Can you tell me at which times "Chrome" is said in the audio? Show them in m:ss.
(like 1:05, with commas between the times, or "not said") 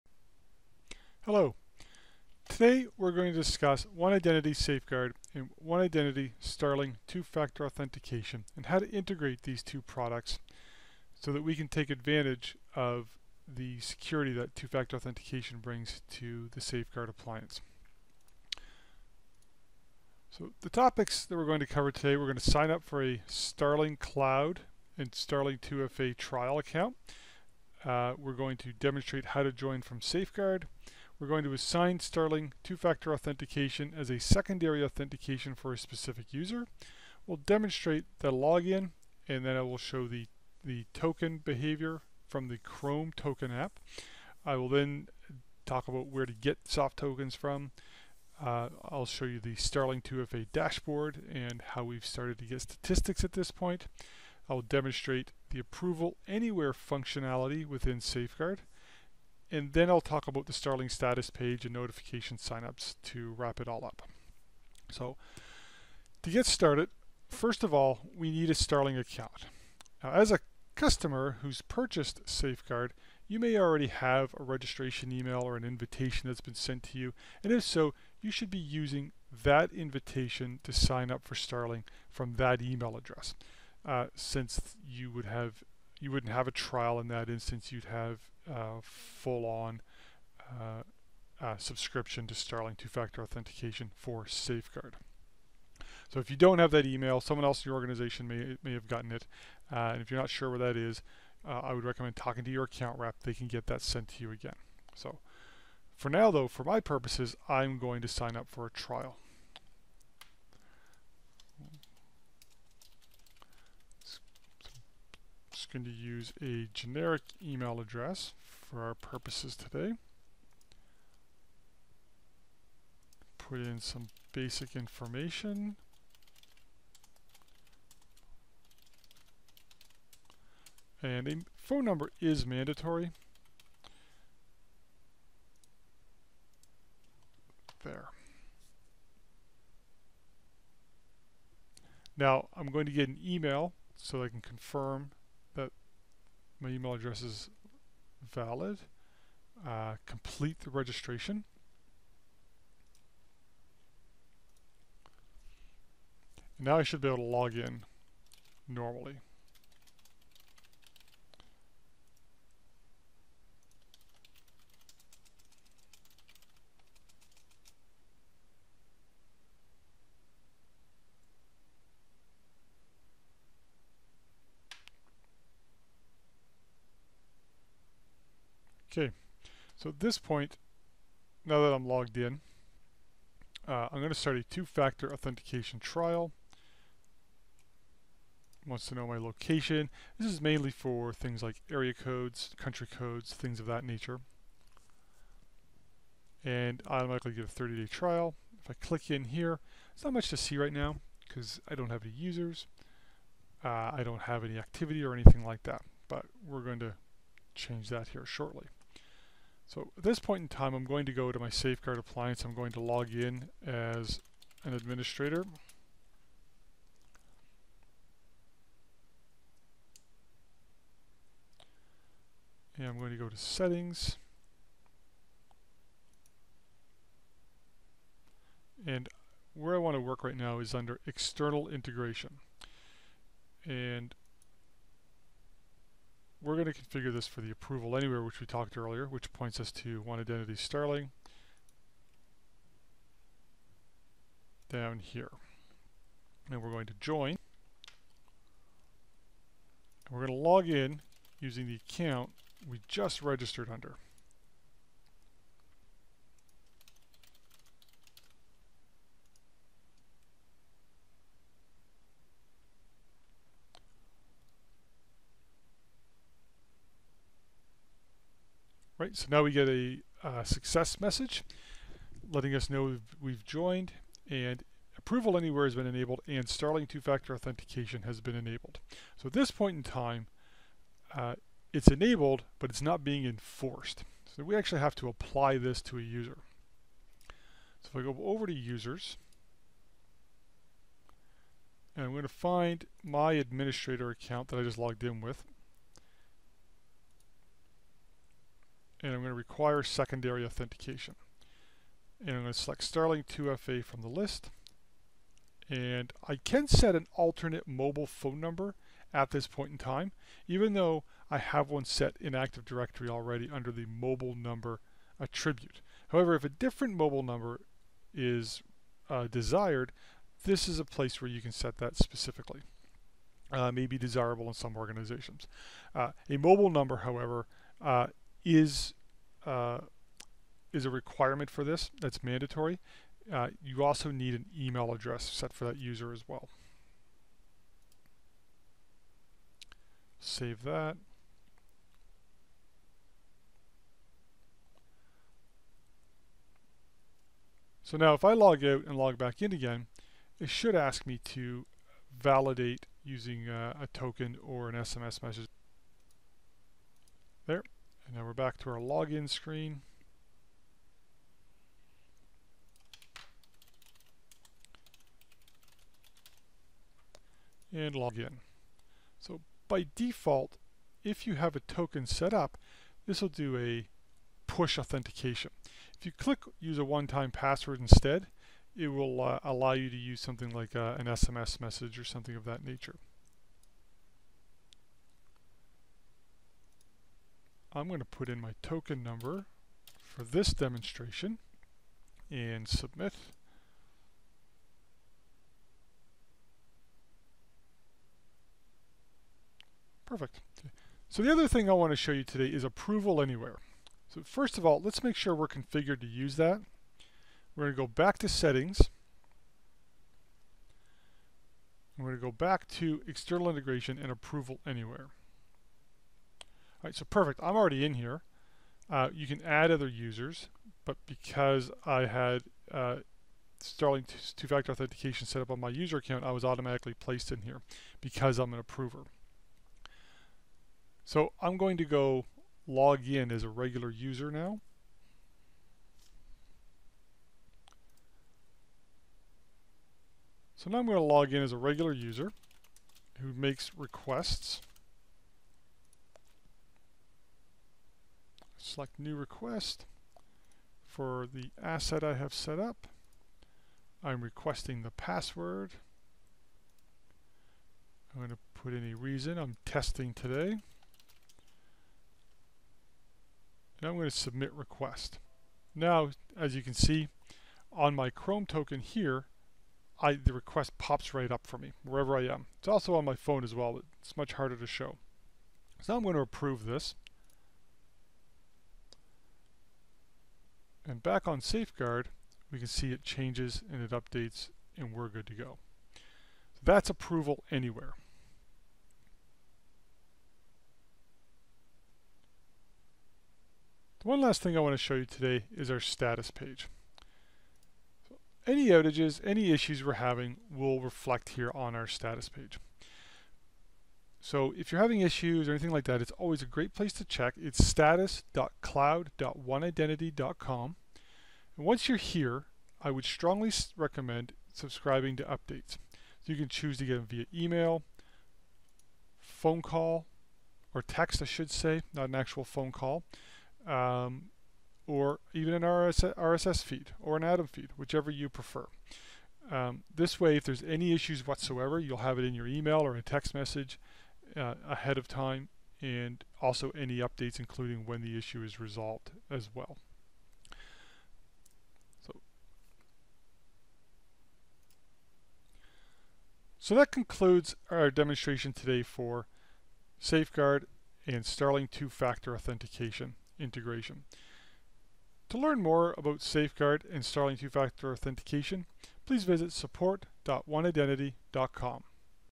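0:42, 7:48.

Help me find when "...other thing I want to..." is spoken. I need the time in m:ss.
6:41.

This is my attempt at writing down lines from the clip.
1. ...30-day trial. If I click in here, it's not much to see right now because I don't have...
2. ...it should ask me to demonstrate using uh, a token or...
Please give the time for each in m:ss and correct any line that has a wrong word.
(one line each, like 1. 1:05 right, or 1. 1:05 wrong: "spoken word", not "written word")
1. 3:17 right
2. 5:50 wrong: "validate", not "demonstrate".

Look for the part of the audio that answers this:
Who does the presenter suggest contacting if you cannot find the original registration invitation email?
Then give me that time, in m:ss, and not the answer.
1:42.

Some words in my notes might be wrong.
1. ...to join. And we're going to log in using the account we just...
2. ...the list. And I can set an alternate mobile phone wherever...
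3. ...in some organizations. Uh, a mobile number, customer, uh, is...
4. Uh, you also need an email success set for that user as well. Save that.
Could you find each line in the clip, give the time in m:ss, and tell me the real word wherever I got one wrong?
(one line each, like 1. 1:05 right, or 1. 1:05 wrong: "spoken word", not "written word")
1. 4:06 right
2. 5:04 wrong: "number", not "wherever"
3. 5:24 wrong: "however", not "customer"
4. 5:33 wrong: "address", not "success".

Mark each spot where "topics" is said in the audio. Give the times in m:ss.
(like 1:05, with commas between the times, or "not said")
0:20.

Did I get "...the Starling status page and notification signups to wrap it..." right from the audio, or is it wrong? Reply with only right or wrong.
right.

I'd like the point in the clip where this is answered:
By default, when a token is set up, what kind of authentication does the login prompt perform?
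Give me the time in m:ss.
6:14.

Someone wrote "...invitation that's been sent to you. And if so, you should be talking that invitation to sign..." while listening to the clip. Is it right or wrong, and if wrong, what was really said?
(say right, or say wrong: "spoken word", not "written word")
wrong: "using", not "talking".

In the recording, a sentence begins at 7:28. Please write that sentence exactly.
select new request for the asset I have set up.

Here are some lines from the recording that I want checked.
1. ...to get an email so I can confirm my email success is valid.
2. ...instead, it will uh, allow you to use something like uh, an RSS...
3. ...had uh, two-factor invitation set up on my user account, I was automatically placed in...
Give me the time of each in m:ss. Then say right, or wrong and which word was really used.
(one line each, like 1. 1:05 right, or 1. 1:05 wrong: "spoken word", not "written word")
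1. 2:22 wrong: "address", not "success"
2. 6:17 wrong: "SMS", not "RSS"
3. 7:02 wrong: "authentication", not "invitation".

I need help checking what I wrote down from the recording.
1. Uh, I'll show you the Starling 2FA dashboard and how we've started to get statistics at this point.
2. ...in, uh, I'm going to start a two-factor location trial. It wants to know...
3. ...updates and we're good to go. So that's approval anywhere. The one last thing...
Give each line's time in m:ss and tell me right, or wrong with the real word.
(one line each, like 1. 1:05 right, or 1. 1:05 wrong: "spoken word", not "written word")
1. 0:48 right
2. 3:02 wrong: "authentication", not "location"
3. 8:03 right.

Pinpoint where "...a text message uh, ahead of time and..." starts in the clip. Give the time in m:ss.
8:52.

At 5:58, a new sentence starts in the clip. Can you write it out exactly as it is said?
And now we're back to our login screen.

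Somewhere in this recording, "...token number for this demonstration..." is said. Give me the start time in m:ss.
6:28.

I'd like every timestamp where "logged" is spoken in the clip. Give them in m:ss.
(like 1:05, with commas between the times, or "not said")
3:01, 4:54.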